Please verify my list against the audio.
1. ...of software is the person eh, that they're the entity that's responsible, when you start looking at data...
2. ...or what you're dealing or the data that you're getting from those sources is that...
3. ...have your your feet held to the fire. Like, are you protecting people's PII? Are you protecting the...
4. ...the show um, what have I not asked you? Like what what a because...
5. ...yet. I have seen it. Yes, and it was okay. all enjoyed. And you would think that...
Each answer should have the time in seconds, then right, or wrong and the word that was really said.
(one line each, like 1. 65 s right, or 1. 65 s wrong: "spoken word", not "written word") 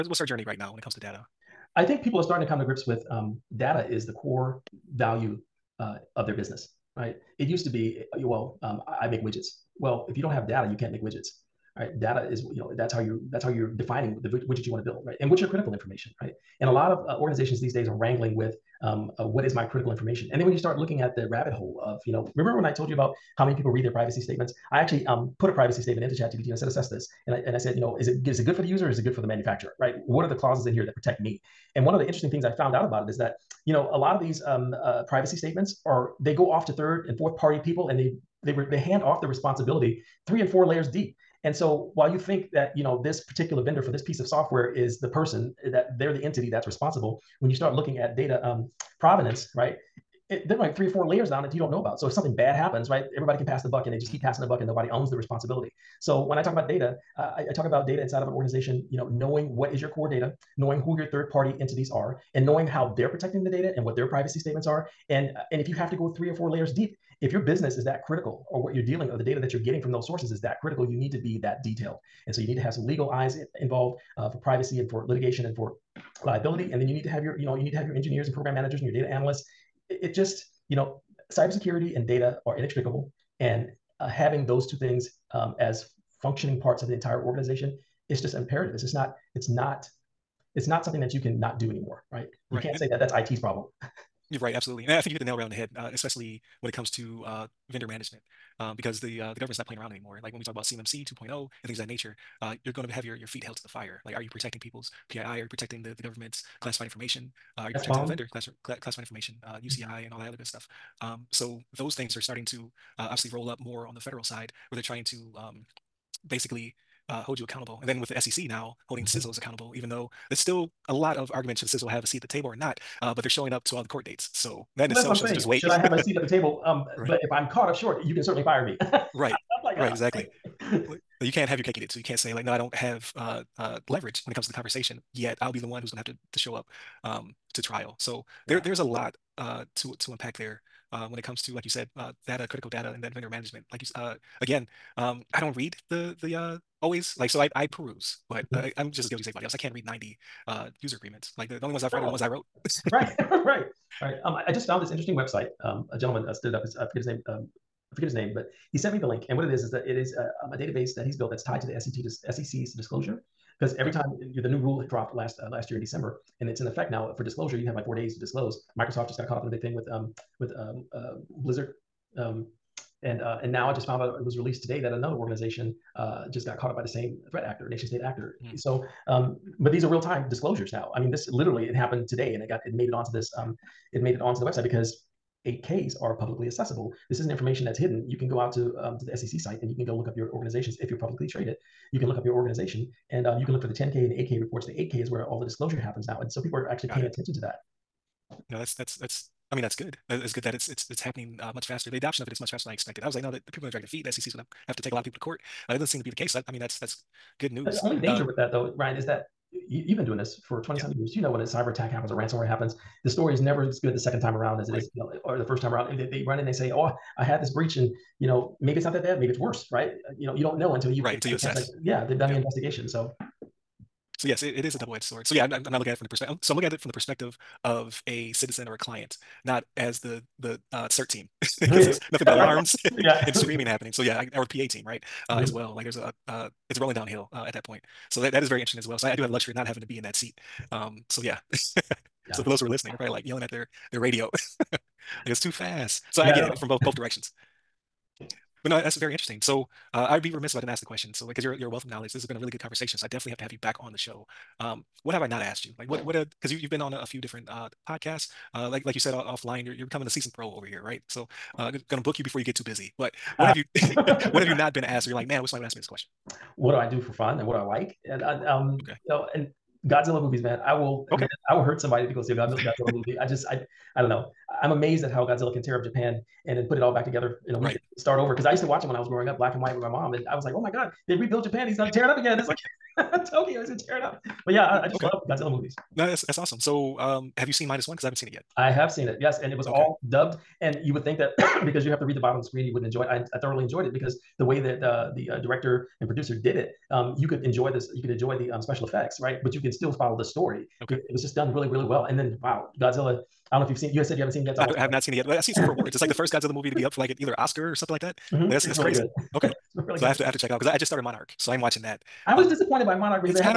1. 44 s right
2. 68 s right
3. 102 s right
4. 253 s right
5. 288 s wrong: "dubbed", not "enjoyed".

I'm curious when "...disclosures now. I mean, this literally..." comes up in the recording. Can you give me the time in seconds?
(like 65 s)
180 s.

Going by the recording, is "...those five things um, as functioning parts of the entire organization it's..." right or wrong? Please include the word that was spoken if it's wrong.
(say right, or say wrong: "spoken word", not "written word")
wrong: "two", not "five".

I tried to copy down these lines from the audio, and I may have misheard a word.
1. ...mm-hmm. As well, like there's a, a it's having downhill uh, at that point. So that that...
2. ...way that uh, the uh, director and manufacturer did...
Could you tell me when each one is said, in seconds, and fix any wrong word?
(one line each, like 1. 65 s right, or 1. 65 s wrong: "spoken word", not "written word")
1. 235 s wrong: "rolling", not "having"
2. 294 s wrong: "producer", not "manufacturer".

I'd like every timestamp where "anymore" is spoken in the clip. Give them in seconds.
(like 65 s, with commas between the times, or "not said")
91 s, 99 s.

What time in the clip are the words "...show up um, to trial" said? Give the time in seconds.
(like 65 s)
136 s.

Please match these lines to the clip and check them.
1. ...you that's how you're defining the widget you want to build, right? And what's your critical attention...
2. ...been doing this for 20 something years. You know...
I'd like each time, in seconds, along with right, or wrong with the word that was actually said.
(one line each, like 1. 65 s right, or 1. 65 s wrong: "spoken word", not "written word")
1. 12 s wrong: "information", not "attention"
2. 209 s right.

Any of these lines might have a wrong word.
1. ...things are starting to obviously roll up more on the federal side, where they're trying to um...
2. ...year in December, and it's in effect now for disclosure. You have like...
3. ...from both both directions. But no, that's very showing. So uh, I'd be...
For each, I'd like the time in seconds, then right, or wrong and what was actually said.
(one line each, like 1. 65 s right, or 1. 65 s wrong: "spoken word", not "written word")
1. 111 s right
2. 165 s right
3. 246 s wrong: "interesting", not "showing".